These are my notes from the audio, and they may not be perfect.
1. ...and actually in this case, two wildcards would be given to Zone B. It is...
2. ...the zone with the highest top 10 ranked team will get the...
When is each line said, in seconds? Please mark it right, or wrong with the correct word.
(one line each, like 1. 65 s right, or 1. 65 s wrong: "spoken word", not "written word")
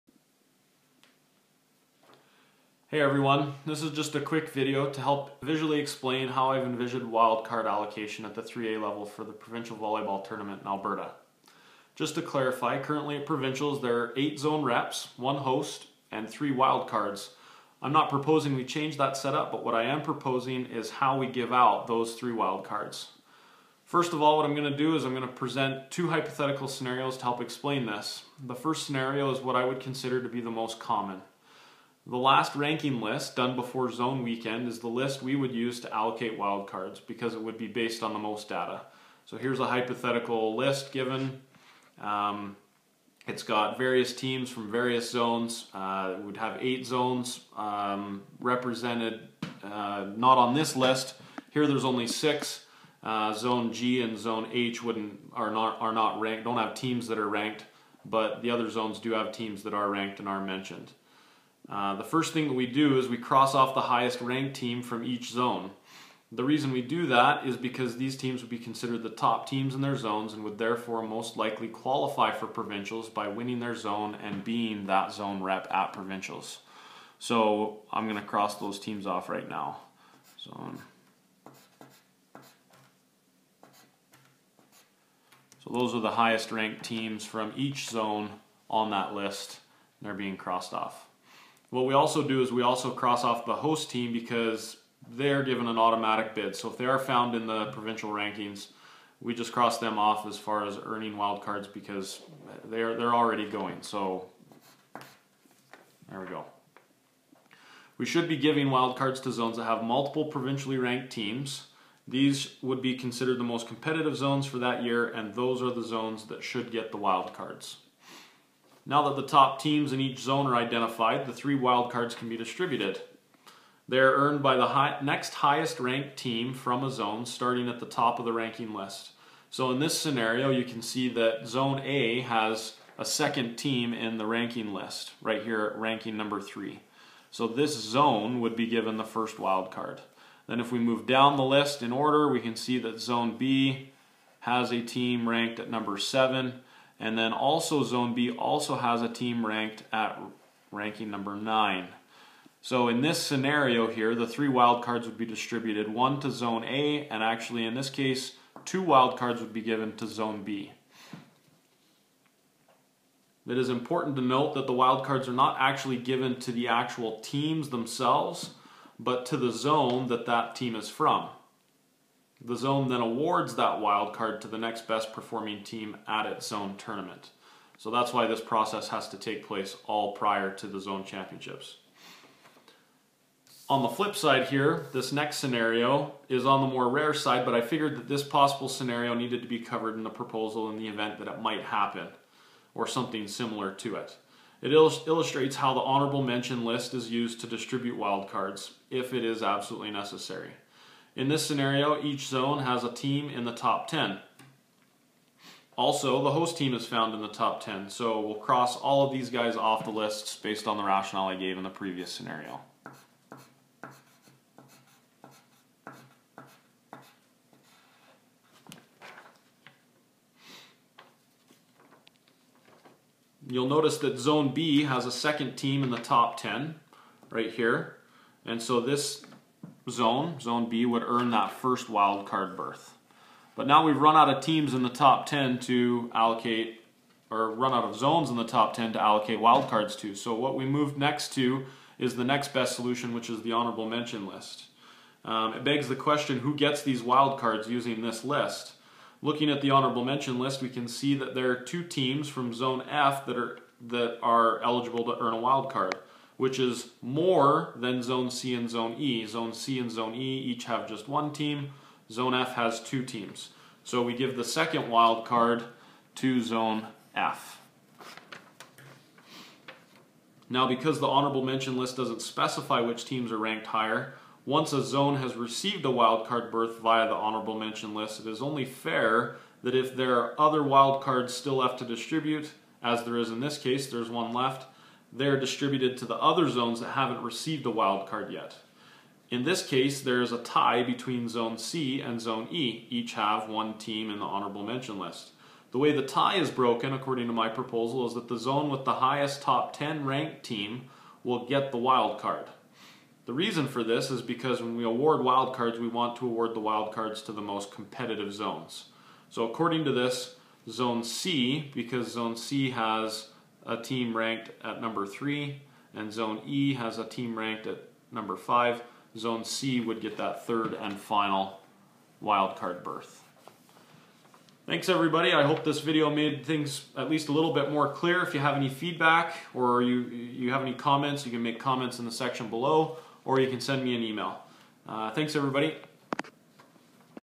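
1. 157 s right
2. 298 s right.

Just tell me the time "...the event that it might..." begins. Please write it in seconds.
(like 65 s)
190 s.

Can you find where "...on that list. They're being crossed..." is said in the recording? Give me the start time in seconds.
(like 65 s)
88 s.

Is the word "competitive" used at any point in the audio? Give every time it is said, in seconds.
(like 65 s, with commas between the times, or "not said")
113 s, 307 s.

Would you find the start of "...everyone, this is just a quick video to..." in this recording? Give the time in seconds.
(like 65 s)
2 s.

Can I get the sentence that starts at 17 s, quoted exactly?
I'm not proposing we change that setup, but what I am proposing is how we give out those 3 wildcards.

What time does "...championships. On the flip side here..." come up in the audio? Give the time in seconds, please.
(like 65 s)
181 s.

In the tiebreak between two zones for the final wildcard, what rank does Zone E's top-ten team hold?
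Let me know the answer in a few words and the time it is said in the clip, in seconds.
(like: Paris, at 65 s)
5, at 318 s.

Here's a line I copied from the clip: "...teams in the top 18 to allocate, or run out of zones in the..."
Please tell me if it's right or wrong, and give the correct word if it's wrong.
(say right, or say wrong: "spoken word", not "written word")
wrong: "10", not "18".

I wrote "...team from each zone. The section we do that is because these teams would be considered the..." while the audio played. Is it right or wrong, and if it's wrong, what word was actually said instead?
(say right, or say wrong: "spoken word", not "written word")
wrong: "reason", not "section".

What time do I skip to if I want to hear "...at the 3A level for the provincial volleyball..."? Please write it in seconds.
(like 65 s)
8 s.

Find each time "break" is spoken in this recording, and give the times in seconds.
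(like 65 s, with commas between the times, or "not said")
not said.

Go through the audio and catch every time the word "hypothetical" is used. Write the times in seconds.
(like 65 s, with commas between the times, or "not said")
26 s, 39 s.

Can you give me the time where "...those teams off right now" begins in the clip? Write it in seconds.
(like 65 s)
78 s.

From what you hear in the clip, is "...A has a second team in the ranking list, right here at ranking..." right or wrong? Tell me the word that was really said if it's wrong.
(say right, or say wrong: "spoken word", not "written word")
right.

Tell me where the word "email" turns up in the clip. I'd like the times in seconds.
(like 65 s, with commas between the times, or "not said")
334 s.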